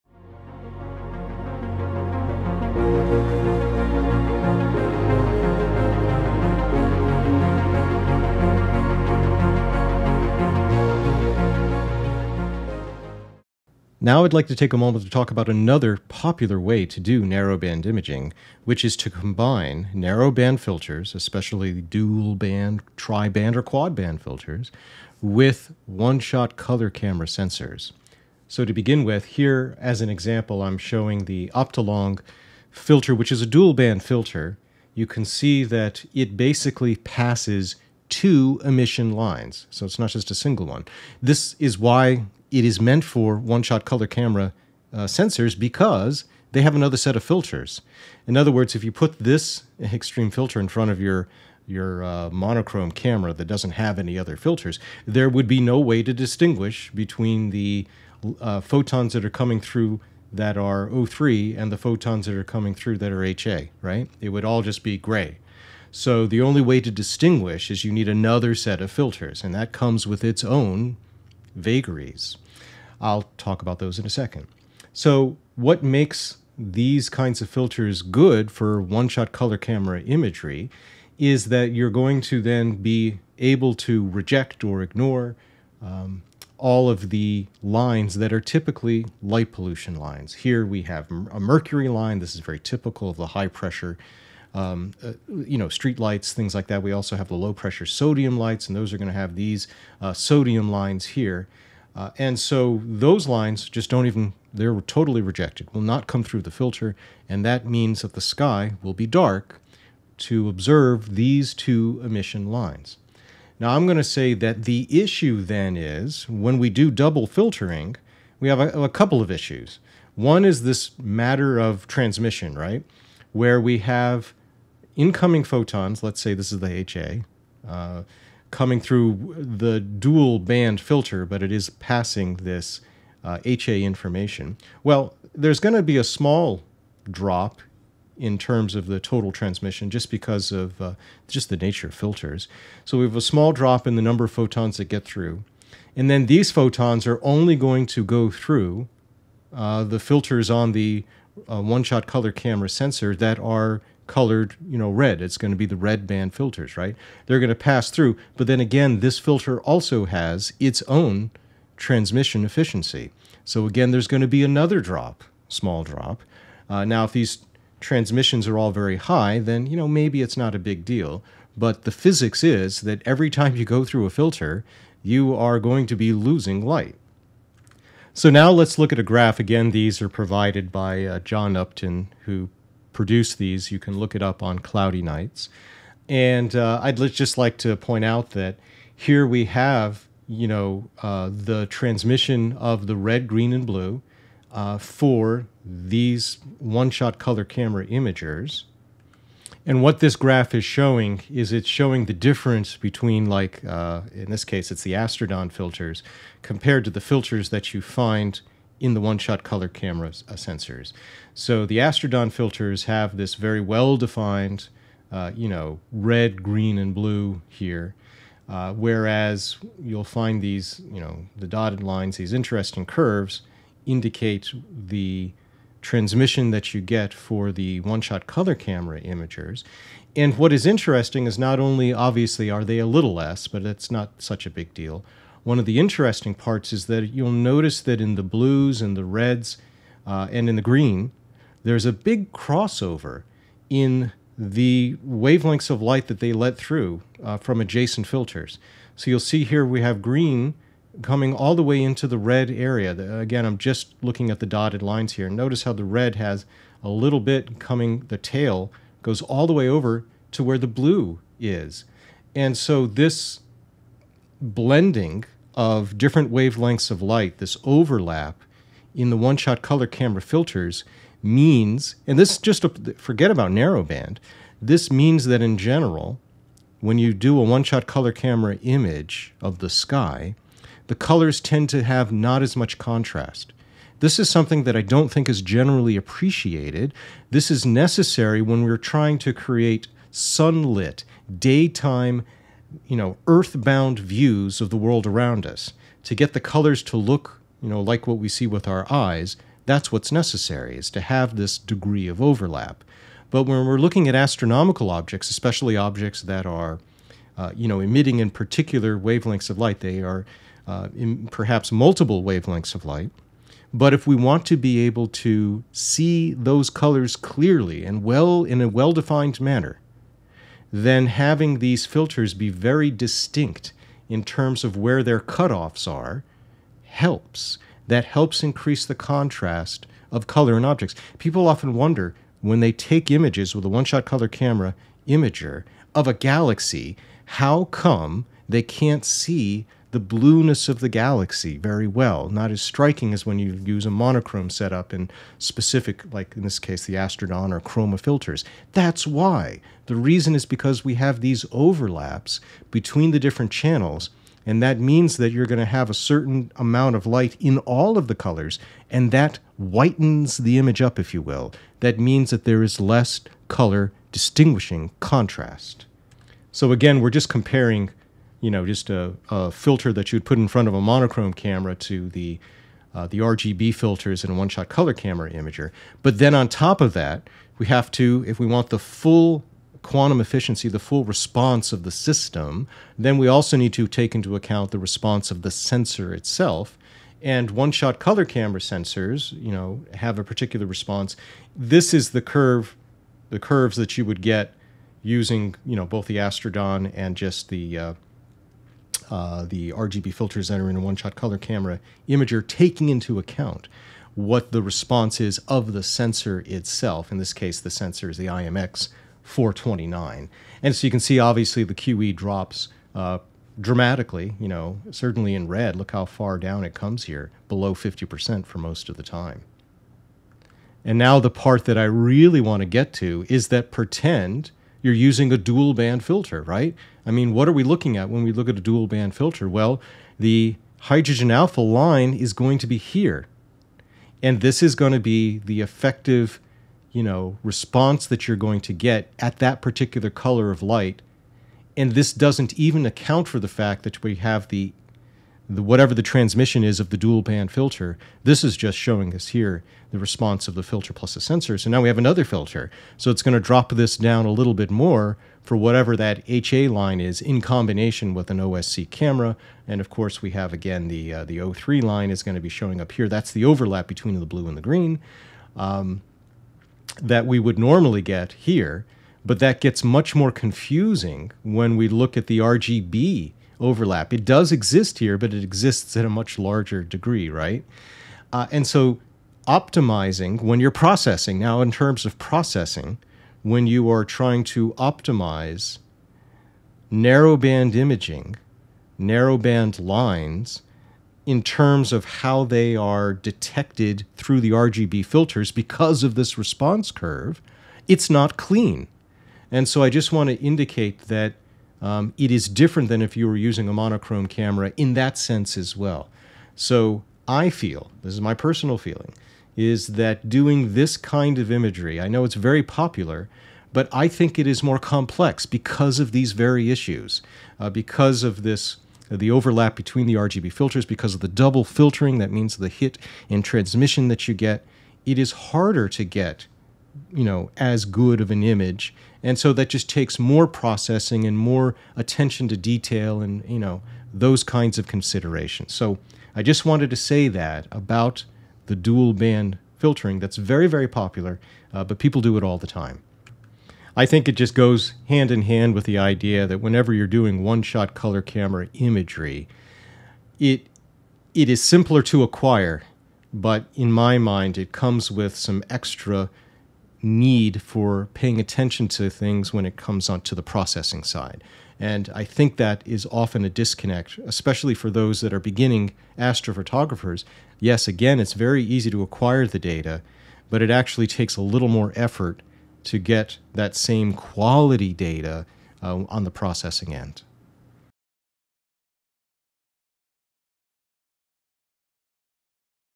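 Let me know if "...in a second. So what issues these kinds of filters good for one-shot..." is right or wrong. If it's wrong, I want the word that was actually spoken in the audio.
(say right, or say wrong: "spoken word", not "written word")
wrong: "makes", not "issues".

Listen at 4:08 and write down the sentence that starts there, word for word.
So you'll see here we have green coming all the way into the red area.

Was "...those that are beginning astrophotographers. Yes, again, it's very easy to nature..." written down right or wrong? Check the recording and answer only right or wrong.
wrong.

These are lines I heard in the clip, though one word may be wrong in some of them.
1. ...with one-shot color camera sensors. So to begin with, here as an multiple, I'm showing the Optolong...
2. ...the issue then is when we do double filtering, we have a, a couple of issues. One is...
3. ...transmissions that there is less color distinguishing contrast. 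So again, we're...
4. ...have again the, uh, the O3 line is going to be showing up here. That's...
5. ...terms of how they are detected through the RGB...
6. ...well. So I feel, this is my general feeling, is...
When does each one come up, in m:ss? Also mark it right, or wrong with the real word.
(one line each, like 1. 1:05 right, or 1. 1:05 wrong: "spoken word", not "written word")
1. 0:25 wrong: "example", not "multiple"
2. 1:54 right
3. 6:01 wrong: "means", not "transmissions"
4. 7:40 right
5. 8:11 right
6. 8:25 wrong: "personal", not "general".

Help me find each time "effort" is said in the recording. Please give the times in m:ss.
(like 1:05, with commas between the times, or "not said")
9:31.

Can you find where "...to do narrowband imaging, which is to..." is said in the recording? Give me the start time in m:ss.
0:16.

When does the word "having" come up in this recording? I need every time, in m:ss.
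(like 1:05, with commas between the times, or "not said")
5:21.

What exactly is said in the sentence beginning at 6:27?
And one-shot color camera sensors, you know, have a particular response.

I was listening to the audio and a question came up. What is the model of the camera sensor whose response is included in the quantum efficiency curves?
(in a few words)
IMX 429.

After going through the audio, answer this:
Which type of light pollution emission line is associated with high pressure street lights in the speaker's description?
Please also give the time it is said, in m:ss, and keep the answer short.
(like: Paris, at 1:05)
mercury line, at 1:31.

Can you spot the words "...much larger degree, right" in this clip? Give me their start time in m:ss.
7:56.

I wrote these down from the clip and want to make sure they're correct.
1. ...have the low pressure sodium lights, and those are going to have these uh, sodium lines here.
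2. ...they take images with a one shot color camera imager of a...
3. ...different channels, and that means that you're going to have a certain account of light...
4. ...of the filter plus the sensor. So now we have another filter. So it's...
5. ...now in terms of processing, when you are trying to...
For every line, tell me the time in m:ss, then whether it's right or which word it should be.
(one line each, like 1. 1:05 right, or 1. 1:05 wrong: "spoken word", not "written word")
1. 1:37 right
2. 5:32 right
3. 5:53 wrong: "amount", not "account"
4. 7:30 right
5. 8:01 right.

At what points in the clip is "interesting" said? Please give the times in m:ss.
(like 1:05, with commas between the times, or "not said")
3:42, 3:50, 3:55.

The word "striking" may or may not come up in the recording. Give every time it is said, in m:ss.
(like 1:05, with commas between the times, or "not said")
5:42.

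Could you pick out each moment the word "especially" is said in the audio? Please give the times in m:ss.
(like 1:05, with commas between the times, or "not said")
0:21, 5:05, 9:24.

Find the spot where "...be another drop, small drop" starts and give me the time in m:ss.
2:44.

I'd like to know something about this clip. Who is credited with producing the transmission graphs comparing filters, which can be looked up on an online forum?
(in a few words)
John Upton.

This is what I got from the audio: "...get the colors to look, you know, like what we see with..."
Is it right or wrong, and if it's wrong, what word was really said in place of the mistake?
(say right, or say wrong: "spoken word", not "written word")
right.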